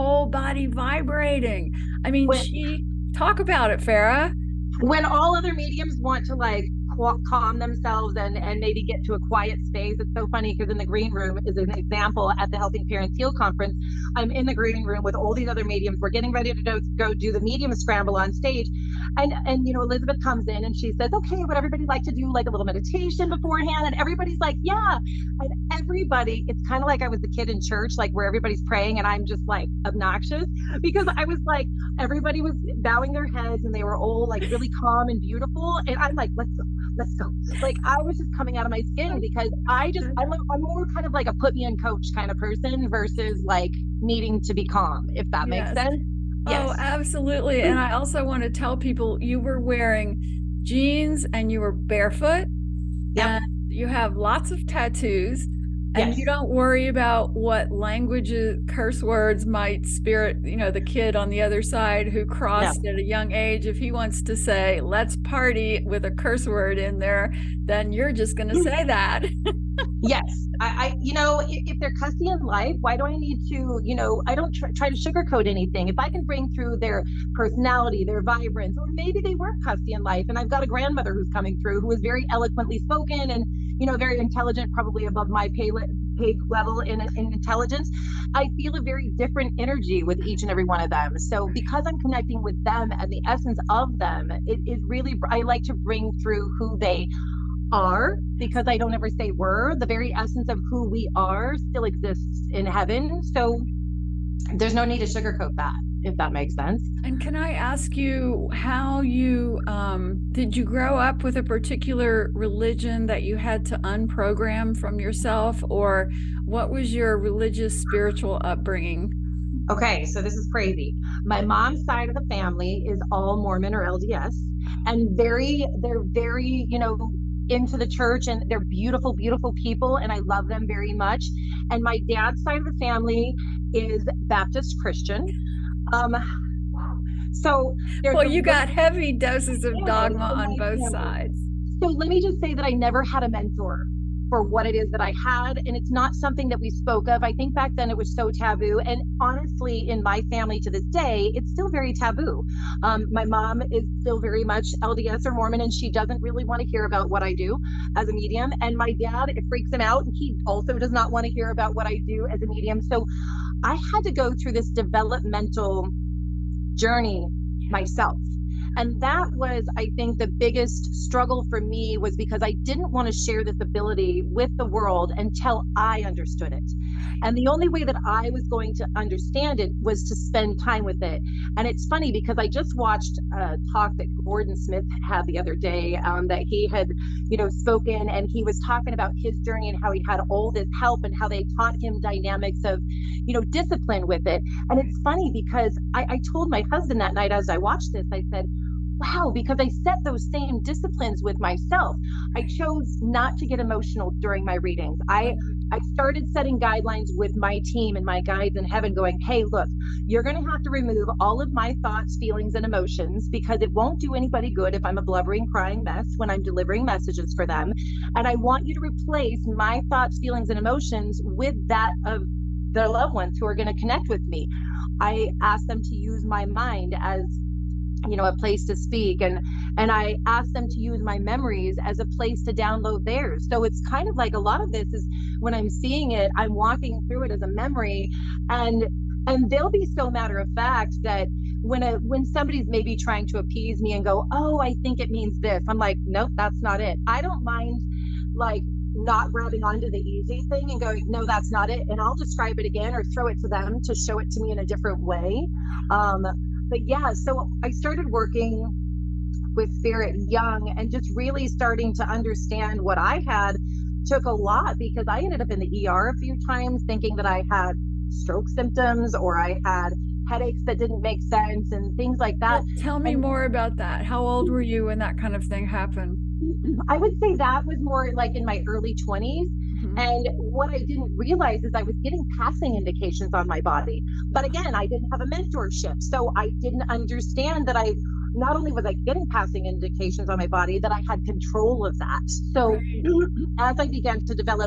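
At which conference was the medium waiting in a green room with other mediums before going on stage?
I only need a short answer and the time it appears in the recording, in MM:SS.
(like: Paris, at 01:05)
Helping Parents Heal, at 00:12.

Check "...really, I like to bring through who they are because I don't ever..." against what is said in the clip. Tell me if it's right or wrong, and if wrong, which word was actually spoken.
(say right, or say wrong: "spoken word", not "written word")
right.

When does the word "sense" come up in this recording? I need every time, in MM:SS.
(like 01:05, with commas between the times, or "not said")
00:45, 01:46, 04:31.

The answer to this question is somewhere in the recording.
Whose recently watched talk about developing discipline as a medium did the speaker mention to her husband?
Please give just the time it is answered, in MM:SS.
03:04.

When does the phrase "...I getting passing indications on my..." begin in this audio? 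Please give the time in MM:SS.
04:48.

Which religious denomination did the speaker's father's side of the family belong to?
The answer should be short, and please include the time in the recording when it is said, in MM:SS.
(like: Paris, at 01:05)
Baptist, at 02:14.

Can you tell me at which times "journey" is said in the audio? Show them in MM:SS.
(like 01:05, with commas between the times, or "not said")
02:46, 03:09.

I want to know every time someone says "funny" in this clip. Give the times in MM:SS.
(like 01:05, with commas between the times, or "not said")
00:10, 03:01, 03:15.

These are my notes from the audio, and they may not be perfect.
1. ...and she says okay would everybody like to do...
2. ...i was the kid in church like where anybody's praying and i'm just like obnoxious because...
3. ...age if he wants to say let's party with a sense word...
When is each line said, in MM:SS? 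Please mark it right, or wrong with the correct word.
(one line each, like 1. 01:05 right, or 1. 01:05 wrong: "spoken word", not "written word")
1. 00:20 right
2. 00:27 wrong: "everybody", not "anybody"
3. 01:03 wrong: "curse", not "sense".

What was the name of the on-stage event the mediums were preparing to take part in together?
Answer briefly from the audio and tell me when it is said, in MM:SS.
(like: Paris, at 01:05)
medium scramble, at 00:17.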